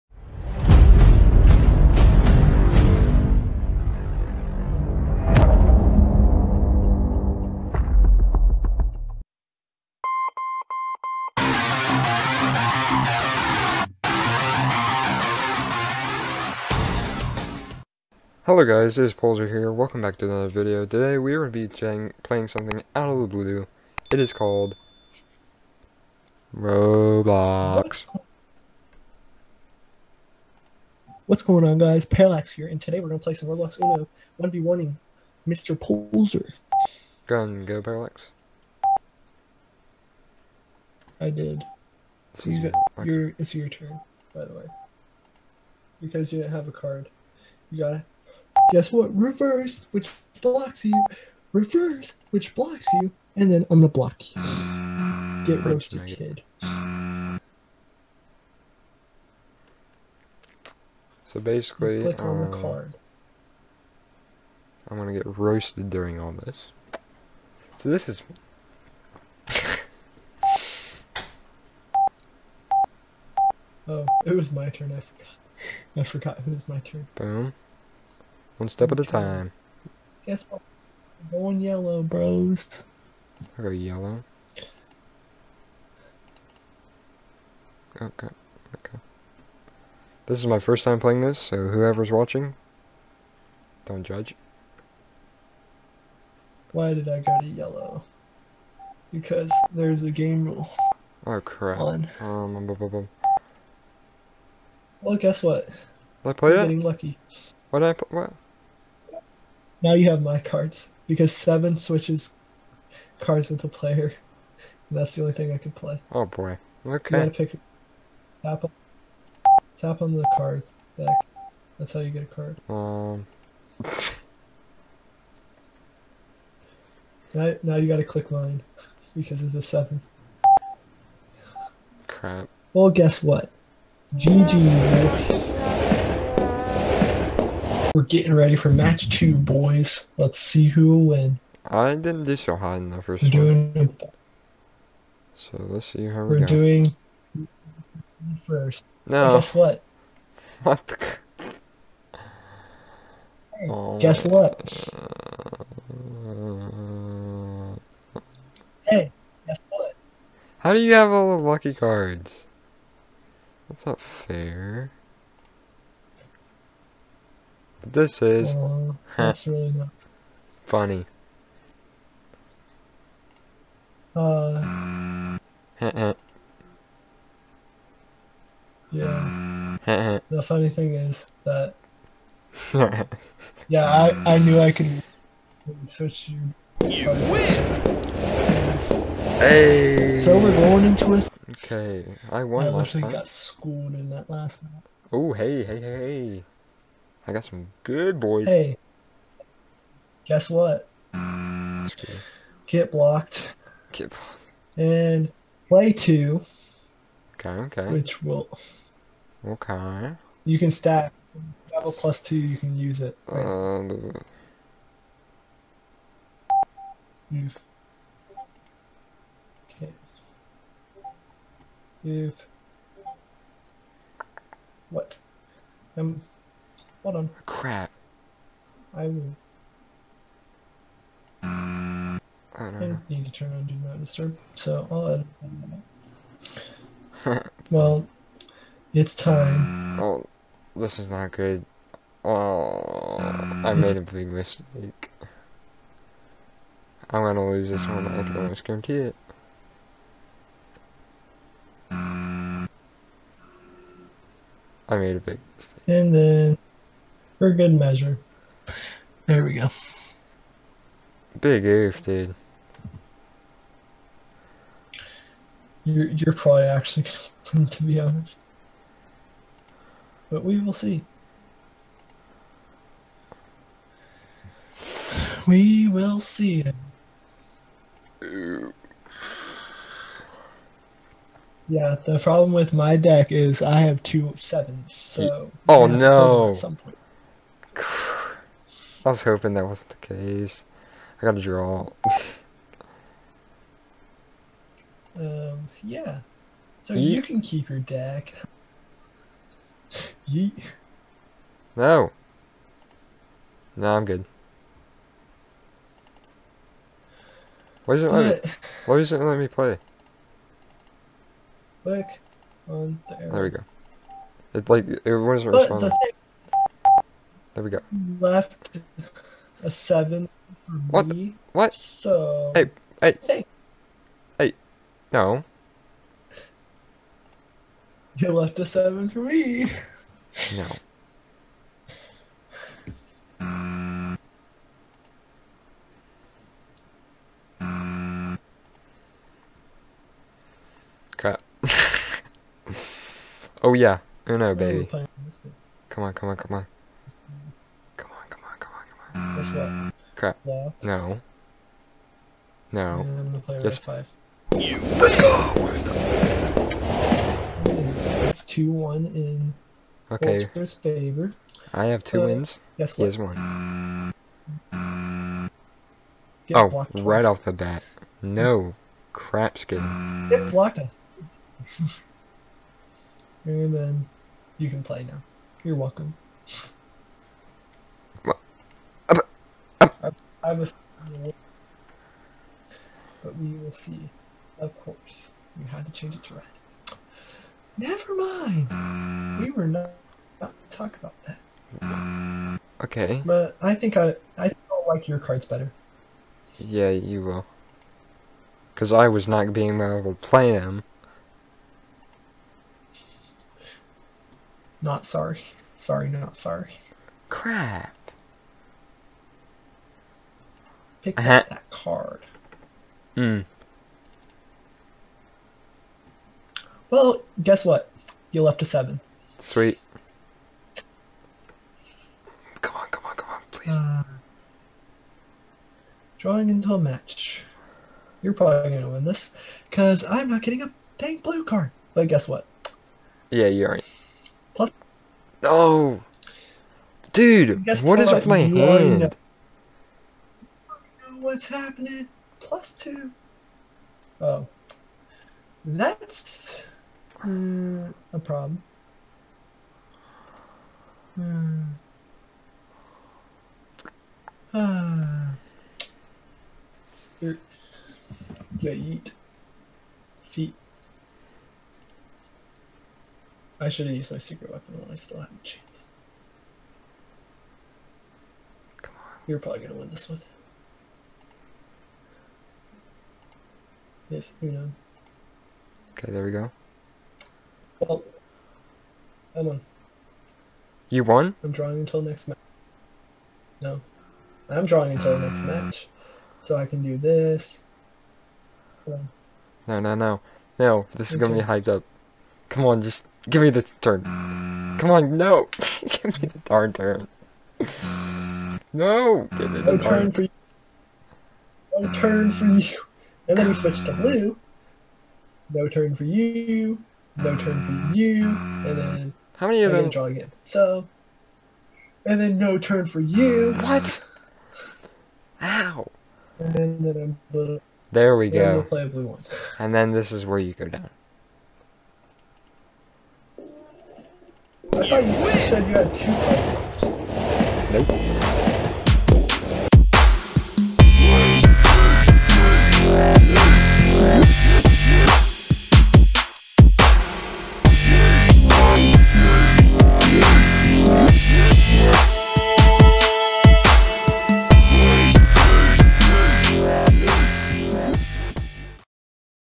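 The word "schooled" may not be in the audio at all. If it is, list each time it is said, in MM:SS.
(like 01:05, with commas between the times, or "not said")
03:13.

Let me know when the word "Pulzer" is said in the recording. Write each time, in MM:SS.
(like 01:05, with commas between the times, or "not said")
00:19, 00:35.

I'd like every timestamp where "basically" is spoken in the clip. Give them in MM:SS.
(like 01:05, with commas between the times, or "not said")
01:01.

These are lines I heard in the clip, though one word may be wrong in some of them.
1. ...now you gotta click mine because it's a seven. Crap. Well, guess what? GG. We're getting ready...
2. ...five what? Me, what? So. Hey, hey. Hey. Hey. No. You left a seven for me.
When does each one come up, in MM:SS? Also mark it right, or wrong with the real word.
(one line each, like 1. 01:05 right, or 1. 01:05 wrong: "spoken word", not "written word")
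1. 02:07 right
2. 05:19 wrong: "seven", not "five".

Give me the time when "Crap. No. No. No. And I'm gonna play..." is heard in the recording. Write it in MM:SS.
05:50.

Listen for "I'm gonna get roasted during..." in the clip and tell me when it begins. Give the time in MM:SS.
01:04.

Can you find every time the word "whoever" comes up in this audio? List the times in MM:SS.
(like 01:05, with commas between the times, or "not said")
01:31.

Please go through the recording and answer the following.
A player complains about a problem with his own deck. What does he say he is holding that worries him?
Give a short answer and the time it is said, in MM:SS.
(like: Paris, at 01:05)
two sevens, at 04:44.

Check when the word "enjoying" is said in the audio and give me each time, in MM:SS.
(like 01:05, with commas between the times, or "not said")
not said.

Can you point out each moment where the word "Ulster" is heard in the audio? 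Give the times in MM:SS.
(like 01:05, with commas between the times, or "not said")
06:00.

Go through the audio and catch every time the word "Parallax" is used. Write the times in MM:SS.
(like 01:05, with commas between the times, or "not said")
00:32, 00:37.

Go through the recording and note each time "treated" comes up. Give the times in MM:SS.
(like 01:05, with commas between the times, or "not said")
not said.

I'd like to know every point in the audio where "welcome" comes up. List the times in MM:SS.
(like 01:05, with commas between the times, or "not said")
00:19, 06:15.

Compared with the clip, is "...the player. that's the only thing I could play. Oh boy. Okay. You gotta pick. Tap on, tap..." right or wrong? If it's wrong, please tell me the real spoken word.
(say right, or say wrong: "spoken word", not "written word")
right.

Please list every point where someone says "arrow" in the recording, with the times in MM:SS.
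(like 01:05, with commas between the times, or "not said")
05:13.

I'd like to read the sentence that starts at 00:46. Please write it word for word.
Because you didn't have a card.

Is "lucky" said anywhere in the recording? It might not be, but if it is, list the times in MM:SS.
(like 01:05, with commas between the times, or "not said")
01:46, 02:41.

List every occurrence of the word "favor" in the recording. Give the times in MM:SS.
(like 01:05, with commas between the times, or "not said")
06:00.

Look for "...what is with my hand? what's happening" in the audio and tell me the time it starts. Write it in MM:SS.
07:17.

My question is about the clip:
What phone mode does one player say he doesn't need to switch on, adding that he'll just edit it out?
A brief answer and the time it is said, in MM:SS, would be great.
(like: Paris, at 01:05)
Do Not Disturb, at 03:53.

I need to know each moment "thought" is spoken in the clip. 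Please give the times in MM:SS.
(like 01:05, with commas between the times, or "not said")
08:44.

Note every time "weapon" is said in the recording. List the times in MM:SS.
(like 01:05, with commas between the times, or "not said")
07:44.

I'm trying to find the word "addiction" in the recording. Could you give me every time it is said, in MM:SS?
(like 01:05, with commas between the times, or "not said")
not said.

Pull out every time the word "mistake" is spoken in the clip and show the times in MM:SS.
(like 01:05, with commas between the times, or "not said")
04:04, 04:15.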